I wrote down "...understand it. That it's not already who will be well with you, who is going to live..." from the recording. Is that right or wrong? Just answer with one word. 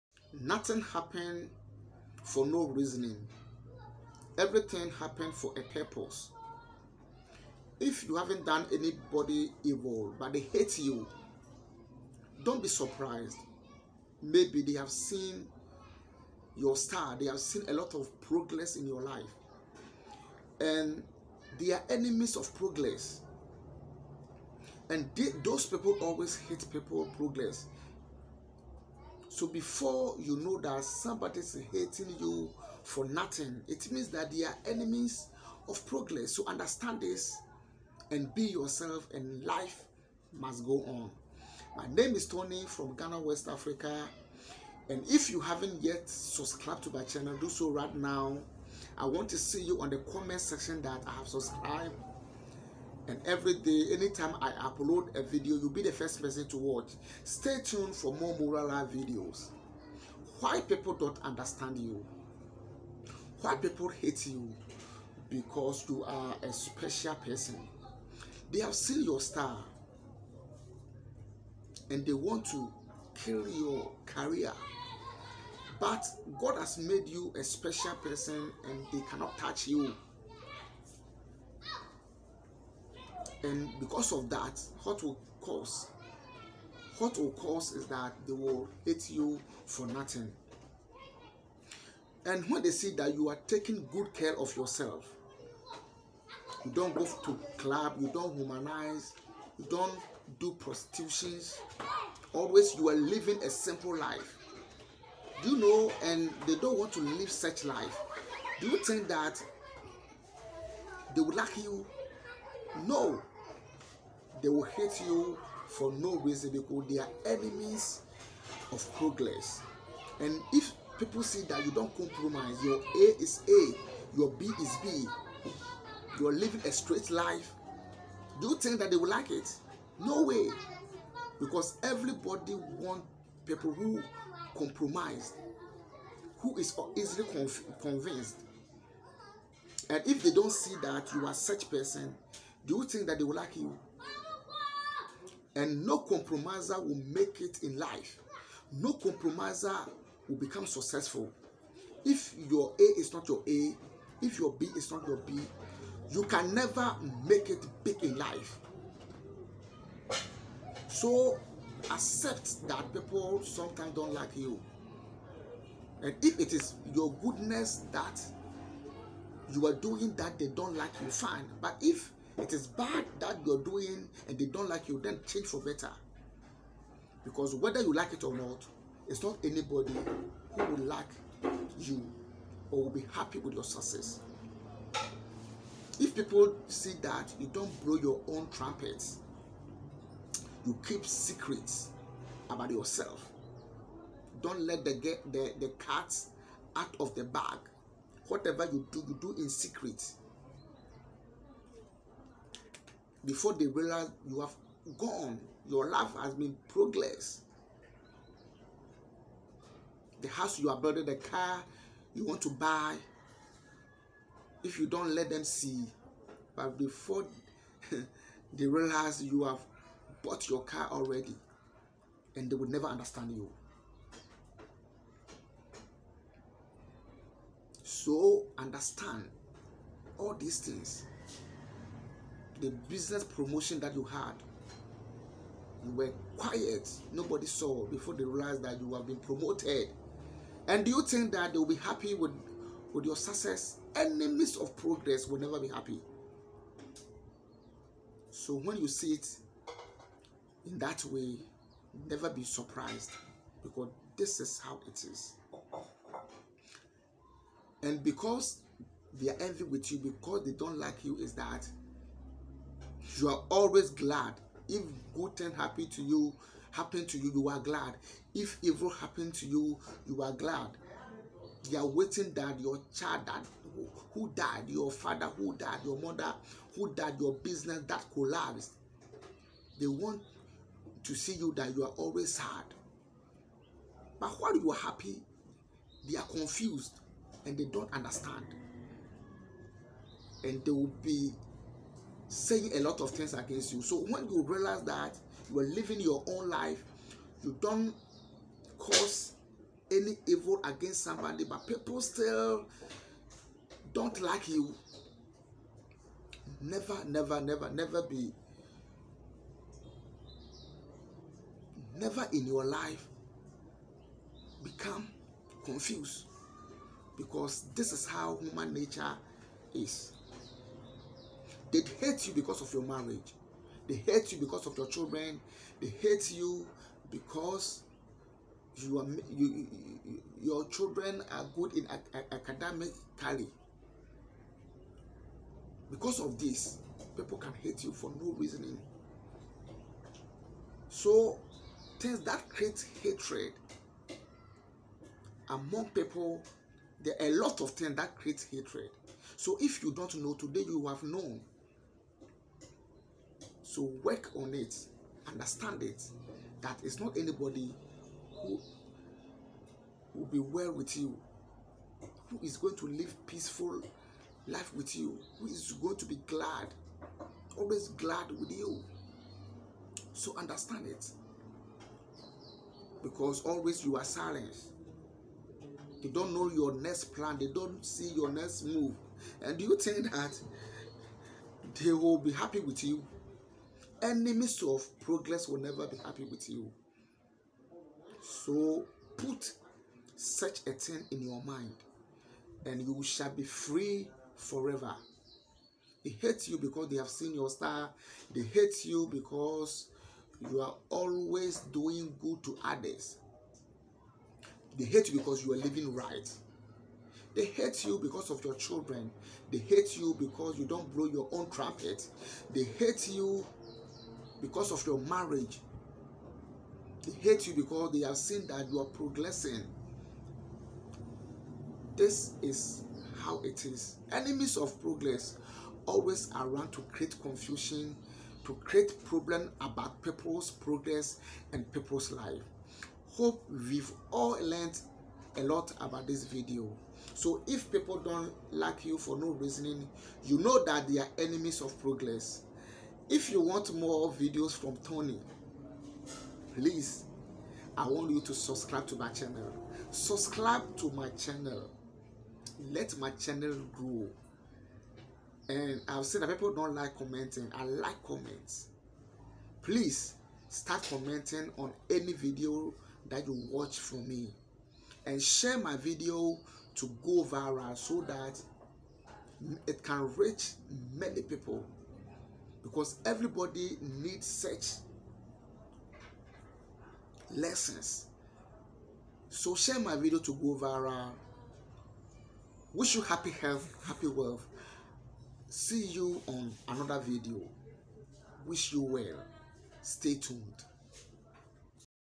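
wrong.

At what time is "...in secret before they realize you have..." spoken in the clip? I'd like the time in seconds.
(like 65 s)
199 s.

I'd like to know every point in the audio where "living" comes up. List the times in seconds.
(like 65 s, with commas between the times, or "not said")
102 s, 126 s, 295 s, 405 s.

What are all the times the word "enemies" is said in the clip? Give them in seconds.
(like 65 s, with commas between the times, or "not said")
21 s, 34 s, 117 s, 243 s, 384 s, 424 s, 441 s.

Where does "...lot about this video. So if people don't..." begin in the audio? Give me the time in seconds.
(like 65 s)
435 s.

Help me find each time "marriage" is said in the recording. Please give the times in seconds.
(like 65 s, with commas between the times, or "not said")
322 s, 414 s.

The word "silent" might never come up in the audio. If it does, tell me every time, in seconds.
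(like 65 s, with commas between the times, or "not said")
374 s.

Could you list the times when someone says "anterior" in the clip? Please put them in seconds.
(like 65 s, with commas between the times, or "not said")
not said.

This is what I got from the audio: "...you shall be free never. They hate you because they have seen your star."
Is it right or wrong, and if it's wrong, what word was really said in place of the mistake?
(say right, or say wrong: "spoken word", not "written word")
wrong: "forever", not "never".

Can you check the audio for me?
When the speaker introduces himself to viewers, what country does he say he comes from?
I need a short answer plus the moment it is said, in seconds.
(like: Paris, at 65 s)
Ghana, at 42 s.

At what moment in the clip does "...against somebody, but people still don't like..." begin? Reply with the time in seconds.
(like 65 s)
300 s.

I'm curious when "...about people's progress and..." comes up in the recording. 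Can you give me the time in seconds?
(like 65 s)
429 s.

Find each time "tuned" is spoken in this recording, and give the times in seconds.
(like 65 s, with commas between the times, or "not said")
57 s, 490 s.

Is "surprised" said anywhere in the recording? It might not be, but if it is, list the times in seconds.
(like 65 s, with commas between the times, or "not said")
12 s, 252 s.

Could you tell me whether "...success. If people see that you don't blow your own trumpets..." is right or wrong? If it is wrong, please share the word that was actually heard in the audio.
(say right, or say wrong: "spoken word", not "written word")
right.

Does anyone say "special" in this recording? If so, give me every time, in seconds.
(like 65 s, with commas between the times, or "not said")
66 s, 77 s.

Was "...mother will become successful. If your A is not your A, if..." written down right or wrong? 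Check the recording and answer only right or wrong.
wrong.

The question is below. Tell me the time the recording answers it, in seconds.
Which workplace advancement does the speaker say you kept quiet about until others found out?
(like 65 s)
232 s.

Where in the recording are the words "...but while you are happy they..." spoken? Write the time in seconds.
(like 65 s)
284 s.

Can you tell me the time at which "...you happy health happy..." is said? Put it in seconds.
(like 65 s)
482 s.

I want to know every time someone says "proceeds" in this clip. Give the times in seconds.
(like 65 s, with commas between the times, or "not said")
not said.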